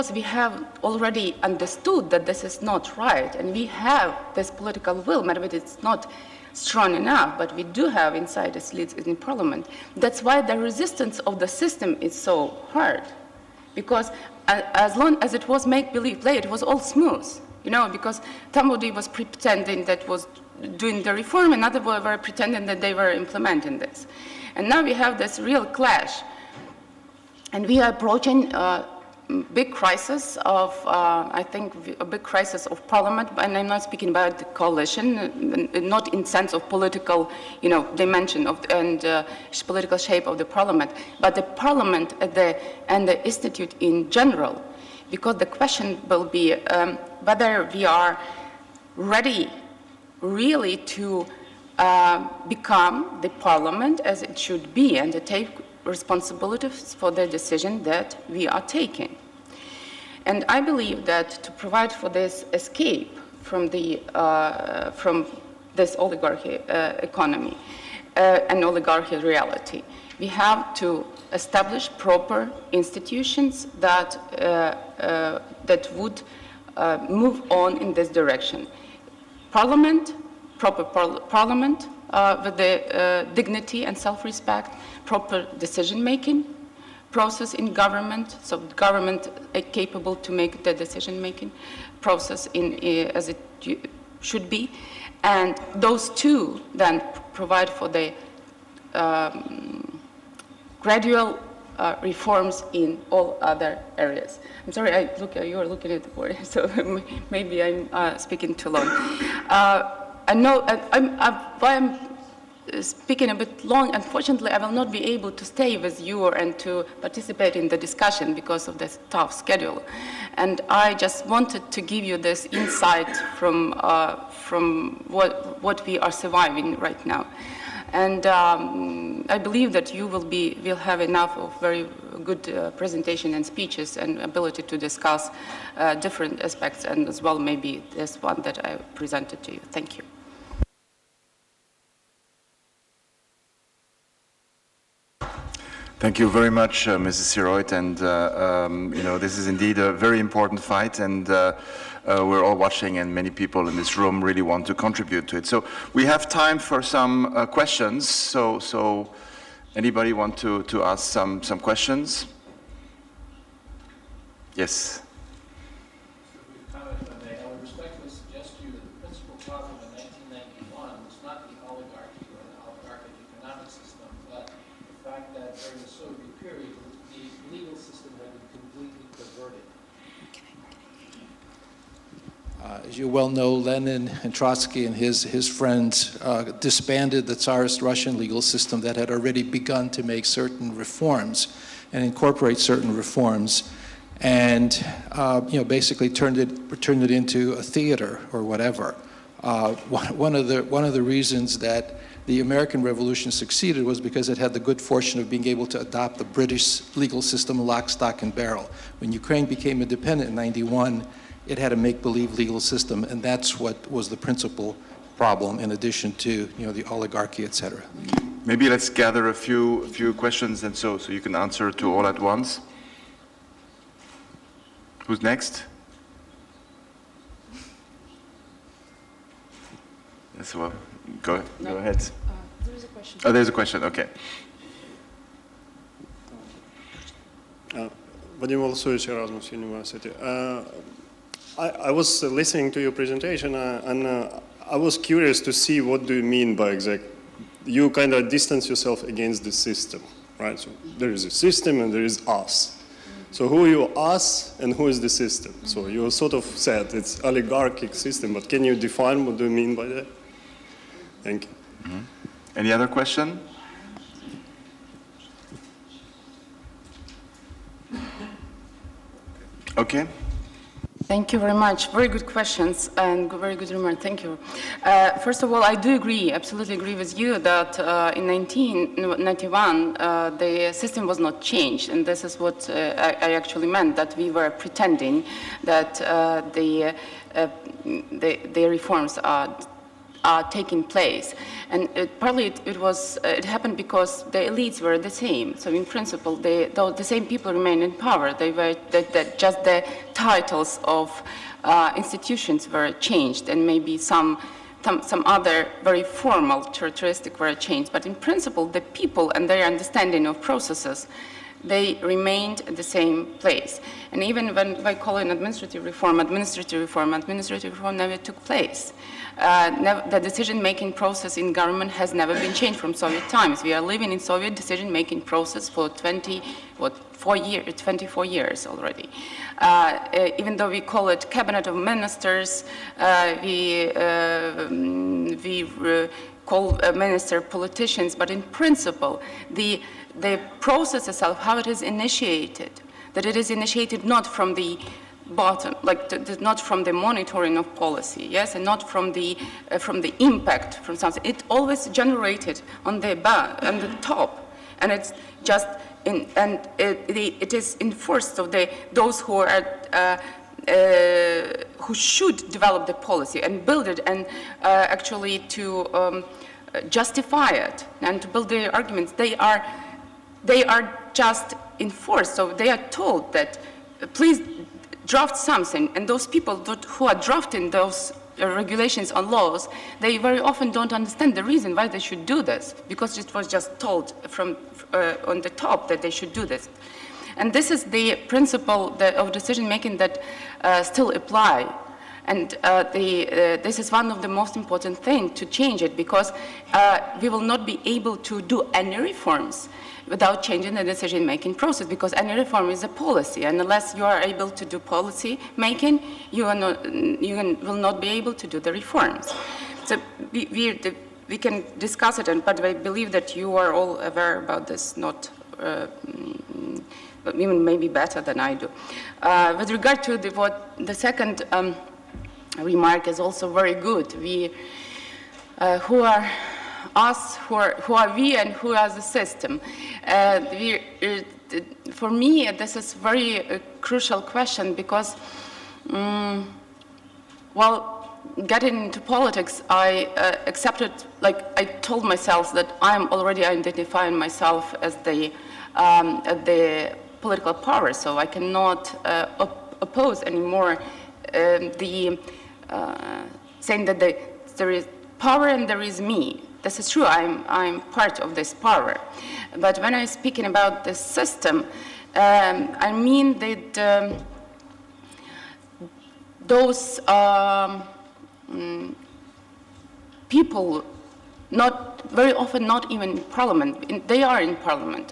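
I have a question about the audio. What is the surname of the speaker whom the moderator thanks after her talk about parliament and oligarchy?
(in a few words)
Syroid.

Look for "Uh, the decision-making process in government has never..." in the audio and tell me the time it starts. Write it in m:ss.
5:19.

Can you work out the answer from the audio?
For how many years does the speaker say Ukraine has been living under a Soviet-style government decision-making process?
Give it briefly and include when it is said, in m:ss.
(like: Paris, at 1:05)
24, at 5:27.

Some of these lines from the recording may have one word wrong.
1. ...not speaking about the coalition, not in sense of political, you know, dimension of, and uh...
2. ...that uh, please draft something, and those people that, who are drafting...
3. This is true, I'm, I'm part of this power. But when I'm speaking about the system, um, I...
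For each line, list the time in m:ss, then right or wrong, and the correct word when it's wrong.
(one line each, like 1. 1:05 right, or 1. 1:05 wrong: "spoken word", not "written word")
1. 0:33 right
2. 6:13 right
3. 7:36 right.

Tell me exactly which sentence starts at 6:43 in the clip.
And unless you are able to do policy making, you, not, you can, will not be able to do the reforms.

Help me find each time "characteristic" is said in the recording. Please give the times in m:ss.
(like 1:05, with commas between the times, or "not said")
5:06.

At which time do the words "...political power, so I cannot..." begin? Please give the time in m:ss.
7:27.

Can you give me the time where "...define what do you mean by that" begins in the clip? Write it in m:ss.
4:18.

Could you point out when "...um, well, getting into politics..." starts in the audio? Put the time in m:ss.
7:15.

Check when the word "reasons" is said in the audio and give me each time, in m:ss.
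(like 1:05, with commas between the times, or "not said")
3:21, 6:21.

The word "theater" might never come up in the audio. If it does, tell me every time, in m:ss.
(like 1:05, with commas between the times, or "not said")
3:17.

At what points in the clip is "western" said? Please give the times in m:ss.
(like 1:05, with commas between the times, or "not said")
not said.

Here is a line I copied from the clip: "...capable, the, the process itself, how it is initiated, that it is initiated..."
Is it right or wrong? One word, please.
wrong.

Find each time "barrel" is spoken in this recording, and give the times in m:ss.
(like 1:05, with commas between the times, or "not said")
3:28.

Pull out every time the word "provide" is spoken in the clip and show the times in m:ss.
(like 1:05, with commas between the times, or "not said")
1:01, 1:37.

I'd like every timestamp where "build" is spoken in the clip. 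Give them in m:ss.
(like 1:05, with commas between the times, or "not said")
6:03, 6:08.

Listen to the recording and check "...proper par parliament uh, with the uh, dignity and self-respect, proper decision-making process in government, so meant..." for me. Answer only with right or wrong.
wrong.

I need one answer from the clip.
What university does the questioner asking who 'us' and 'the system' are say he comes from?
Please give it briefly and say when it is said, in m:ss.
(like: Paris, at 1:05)
Erasmus University, at 3:59.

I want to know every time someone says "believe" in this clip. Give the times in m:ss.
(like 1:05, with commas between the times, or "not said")
0:15, 1:00, 2:09, 3:31, 6:52.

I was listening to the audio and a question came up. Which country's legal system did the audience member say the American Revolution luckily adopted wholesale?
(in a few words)
British.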